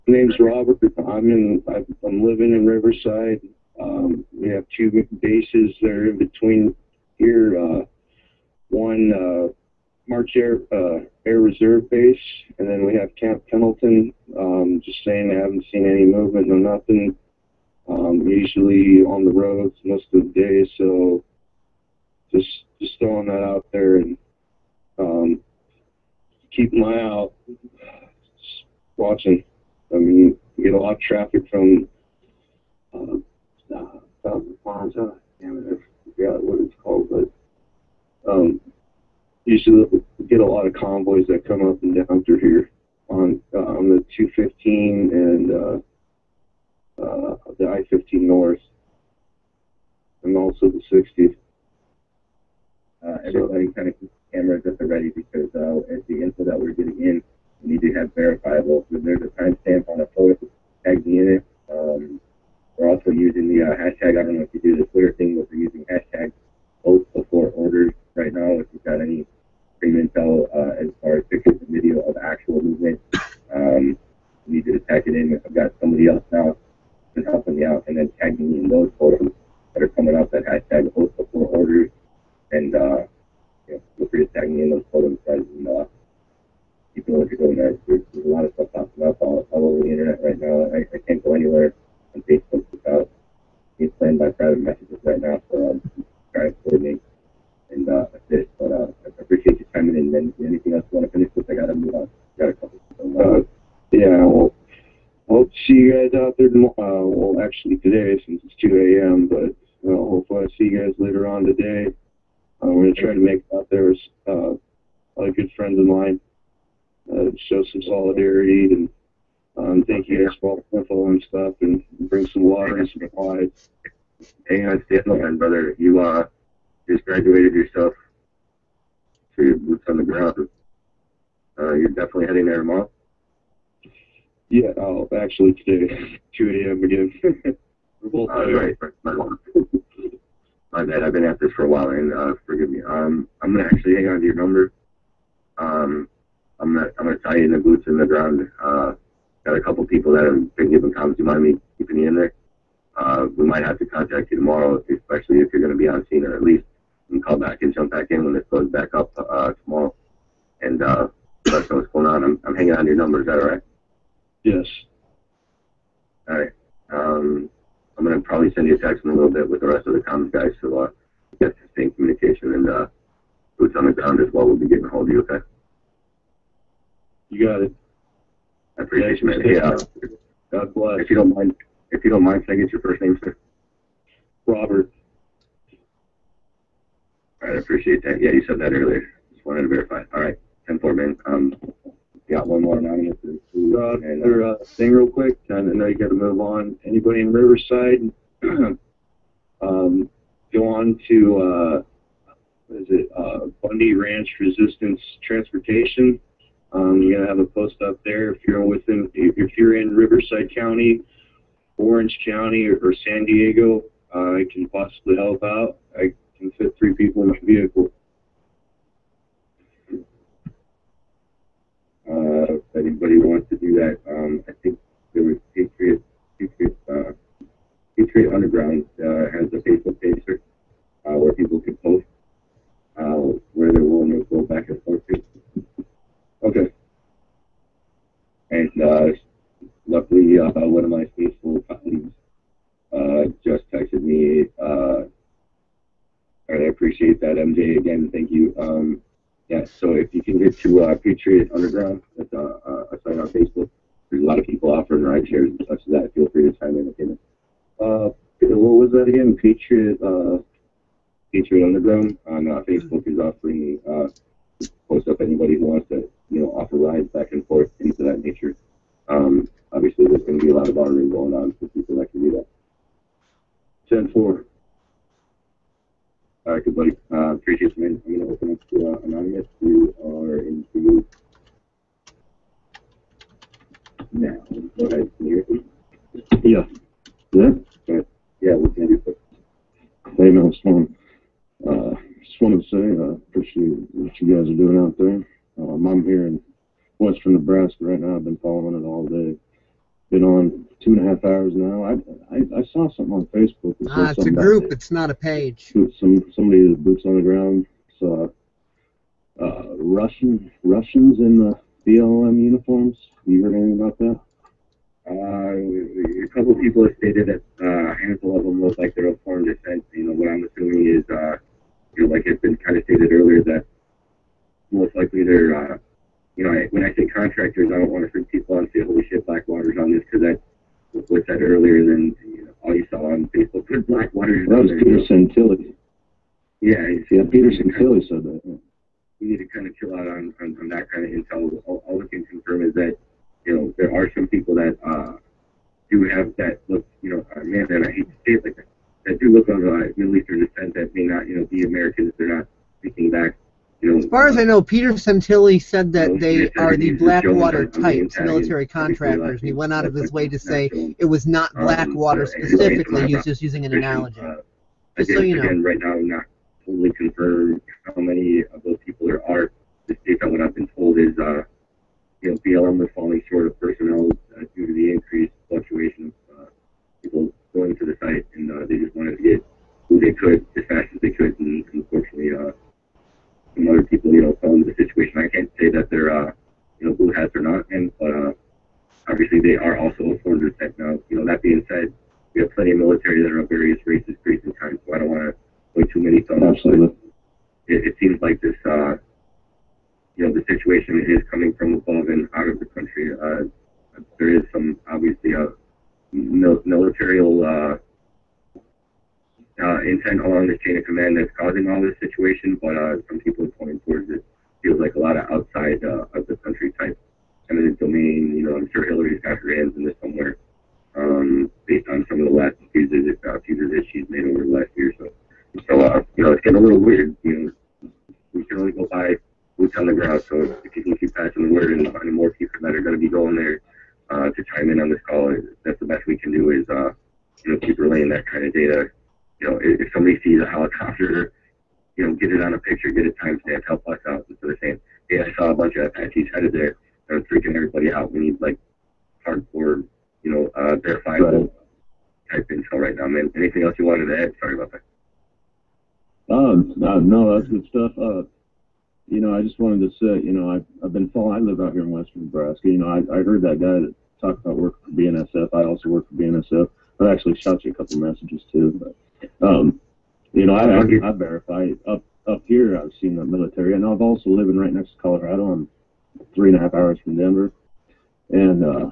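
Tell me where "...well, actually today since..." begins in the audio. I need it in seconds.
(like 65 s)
107 s.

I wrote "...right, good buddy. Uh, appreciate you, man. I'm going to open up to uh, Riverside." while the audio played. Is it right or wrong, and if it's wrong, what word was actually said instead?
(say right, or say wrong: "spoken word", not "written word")
wrong: "Anonymous", not "Riverside".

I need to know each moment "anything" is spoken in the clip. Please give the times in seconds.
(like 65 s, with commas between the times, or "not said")
100 s, 313 s, 453 s.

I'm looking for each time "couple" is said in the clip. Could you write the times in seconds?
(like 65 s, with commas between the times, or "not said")
102 s, 149 s, 316 s, 467 s.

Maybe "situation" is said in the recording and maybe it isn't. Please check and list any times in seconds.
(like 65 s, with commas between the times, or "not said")
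384 s, 400 s, 411 s.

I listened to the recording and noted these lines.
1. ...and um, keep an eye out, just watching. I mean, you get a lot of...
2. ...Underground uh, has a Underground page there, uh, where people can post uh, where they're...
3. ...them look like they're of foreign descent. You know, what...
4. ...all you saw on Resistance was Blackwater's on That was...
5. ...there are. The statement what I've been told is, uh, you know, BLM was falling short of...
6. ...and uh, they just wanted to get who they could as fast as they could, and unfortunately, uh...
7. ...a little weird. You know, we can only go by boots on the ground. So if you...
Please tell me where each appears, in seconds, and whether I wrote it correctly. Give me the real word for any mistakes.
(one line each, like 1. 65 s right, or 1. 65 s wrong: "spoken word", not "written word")
1. 23 s right
2. 228 s wrong: "Facebook", not "Underground"
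3. 318 s right
4. 332 s wrong: "Facebook", not "Resistance"
5. 369 s right
6. 378 s right
7. 426 s right.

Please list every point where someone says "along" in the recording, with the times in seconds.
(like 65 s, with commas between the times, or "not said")
410 s.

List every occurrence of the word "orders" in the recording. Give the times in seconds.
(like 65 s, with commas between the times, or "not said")
67 s, 81 s.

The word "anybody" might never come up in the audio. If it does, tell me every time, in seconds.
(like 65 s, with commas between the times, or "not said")
196 s, 222 s, 265 s.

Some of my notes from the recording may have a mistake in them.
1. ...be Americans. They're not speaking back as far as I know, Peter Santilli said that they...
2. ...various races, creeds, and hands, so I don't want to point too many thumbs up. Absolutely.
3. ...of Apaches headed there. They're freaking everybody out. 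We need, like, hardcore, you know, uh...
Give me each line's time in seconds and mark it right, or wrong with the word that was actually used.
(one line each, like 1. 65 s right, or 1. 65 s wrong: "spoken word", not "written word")
1. 351 s right
2. 393 s wrong: "kinds", not "hands"
3. 445 s right.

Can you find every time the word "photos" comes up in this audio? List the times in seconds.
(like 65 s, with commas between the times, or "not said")
60 s, 78 s, 84 s.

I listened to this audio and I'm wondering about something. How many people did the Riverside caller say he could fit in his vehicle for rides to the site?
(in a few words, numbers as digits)
3.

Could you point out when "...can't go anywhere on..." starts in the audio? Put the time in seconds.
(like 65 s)
91 s.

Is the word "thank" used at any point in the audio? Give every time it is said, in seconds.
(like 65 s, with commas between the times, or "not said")
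119 s, 248 s.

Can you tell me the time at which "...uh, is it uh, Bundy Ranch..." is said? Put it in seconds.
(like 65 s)
201 s.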